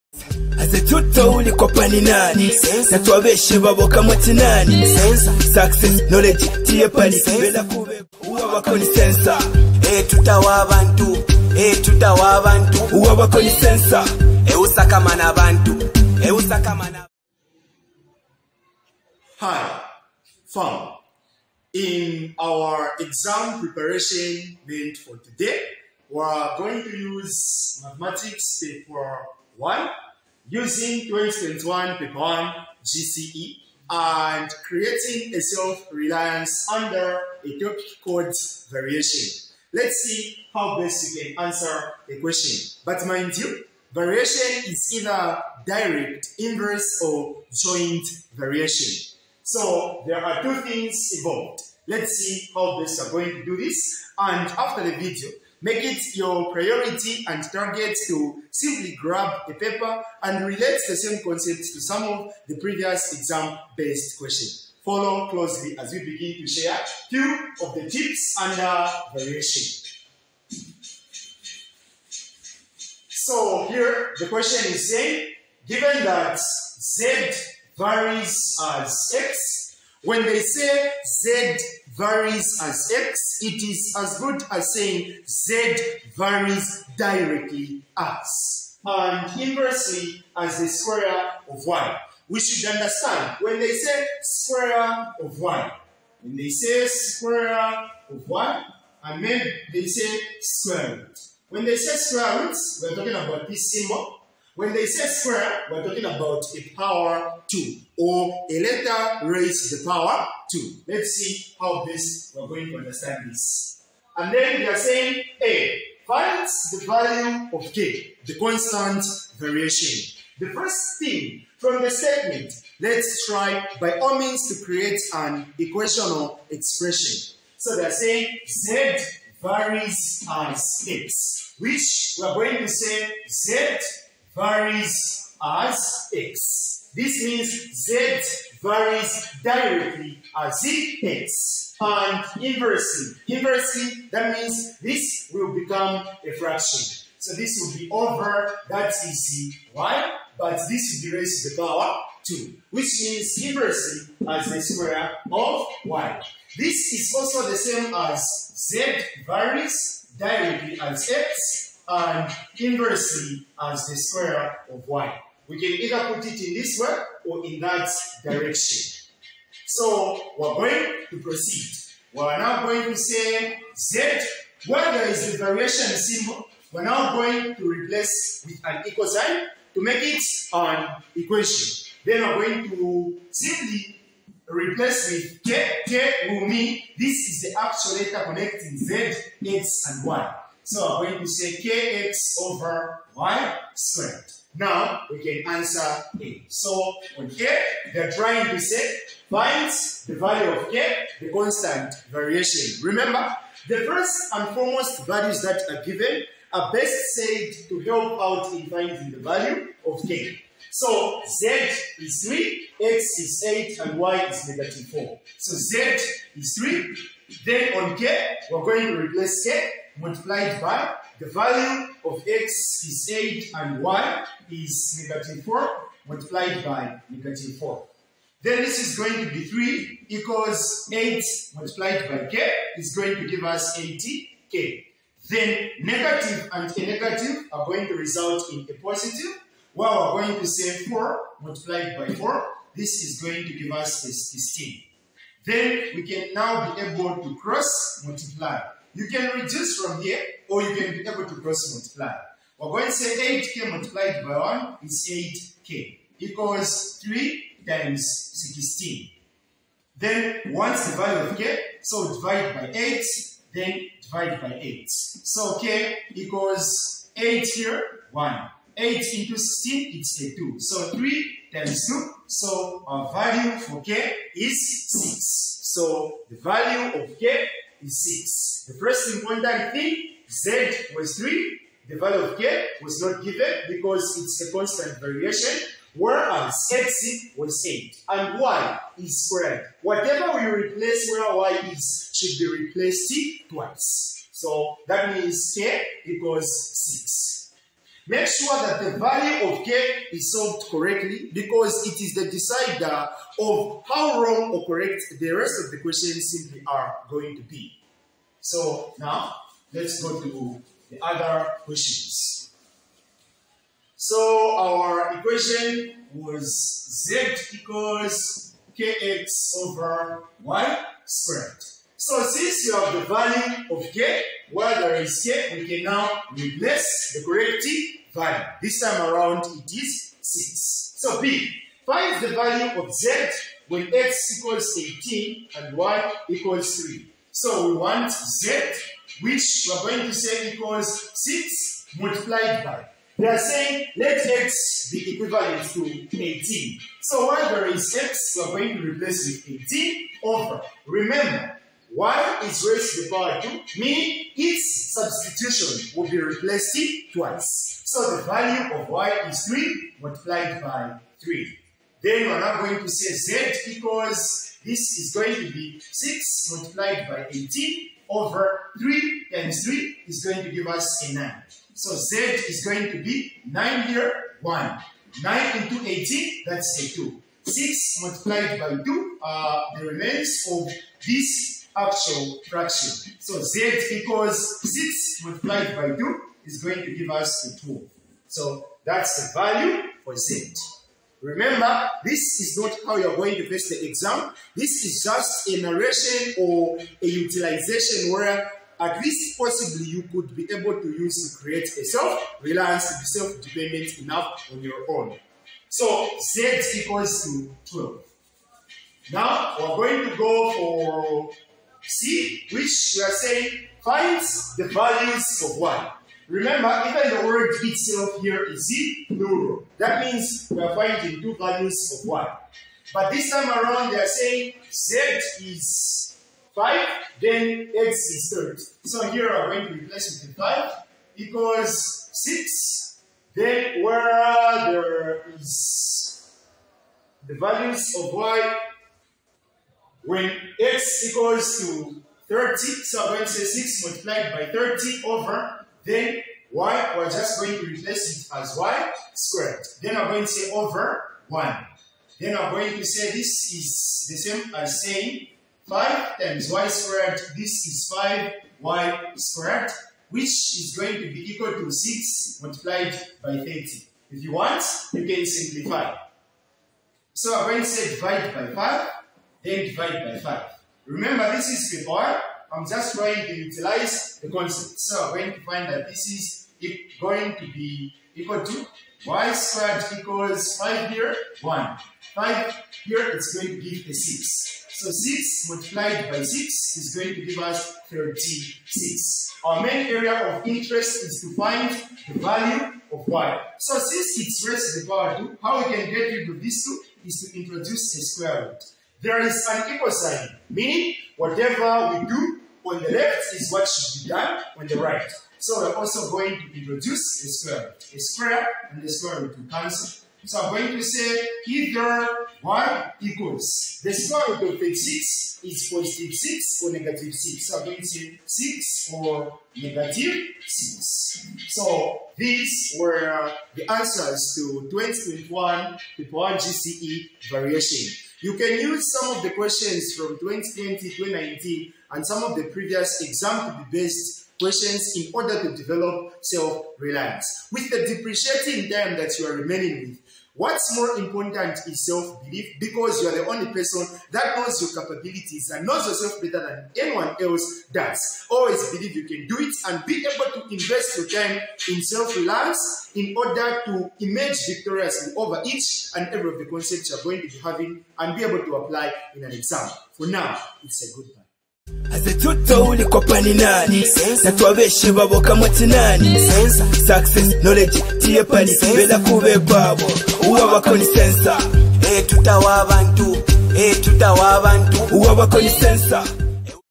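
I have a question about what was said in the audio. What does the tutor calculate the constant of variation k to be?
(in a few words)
6.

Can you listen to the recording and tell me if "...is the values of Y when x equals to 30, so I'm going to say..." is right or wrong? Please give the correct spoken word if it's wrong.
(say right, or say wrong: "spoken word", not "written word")
right.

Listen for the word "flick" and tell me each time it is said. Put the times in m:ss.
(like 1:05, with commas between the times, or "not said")
not said.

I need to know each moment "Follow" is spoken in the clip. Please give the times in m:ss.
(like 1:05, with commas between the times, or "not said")
1:04.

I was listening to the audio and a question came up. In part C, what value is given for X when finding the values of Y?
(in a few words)
30.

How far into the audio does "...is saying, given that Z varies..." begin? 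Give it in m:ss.
1:14.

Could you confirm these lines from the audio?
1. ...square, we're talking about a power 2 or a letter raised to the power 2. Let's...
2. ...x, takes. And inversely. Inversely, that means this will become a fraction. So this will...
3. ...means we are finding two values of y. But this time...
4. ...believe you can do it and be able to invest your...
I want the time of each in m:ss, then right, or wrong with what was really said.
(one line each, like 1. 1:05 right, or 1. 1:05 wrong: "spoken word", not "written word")
1. 1:45 right
2. 2:20 right
3. 7:00 right
4. 9:08 right.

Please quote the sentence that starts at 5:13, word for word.
So our equation was z equals kx over y squared.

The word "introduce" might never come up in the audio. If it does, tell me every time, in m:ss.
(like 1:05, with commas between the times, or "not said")
8:17, 8:26.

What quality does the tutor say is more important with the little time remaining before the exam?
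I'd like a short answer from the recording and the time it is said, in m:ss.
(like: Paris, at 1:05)
self belief, at 9:01.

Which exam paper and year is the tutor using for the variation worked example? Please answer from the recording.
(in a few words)
2021 Paper 1 GCE.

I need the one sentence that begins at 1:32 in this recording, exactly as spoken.
We should understand when they say square of Y, when they say square of y, I mean they say square root.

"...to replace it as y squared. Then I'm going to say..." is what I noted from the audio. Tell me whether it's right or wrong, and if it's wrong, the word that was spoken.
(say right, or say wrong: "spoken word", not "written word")
right.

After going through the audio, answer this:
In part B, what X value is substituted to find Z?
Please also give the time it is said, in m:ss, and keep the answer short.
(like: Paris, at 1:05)
18, at 5:33.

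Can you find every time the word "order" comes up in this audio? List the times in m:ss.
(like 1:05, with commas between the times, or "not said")
8:55, 9:13.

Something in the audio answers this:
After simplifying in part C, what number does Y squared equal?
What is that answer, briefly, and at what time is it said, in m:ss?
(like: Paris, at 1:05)
36, at 8:07.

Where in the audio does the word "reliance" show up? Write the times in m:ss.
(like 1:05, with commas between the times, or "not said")
0:35, 6:41, 8:56, 9:12.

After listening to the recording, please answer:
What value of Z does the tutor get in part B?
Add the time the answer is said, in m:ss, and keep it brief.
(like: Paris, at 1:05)
12, at 6:46.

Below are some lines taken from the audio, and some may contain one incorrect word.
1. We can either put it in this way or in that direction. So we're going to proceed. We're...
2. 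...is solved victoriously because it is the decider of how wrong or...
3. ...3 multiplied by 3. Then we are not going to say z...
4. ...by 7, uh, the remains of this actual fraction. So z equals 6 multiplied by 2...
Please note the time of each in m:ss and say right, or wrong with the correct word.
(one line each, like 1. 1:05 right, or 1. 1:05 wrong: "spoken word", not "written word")
1. 2:45 right
2. 5:00 wrong: "correctly", not "victoriously"
3. 5:59 right
4. 6:18 wrong: "2", not "7".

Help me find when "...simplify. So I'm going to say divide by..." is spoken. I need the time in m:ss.
7:45.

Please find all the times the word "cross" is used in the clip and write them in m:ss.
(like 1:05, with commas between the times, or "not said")
4:07, 4:11.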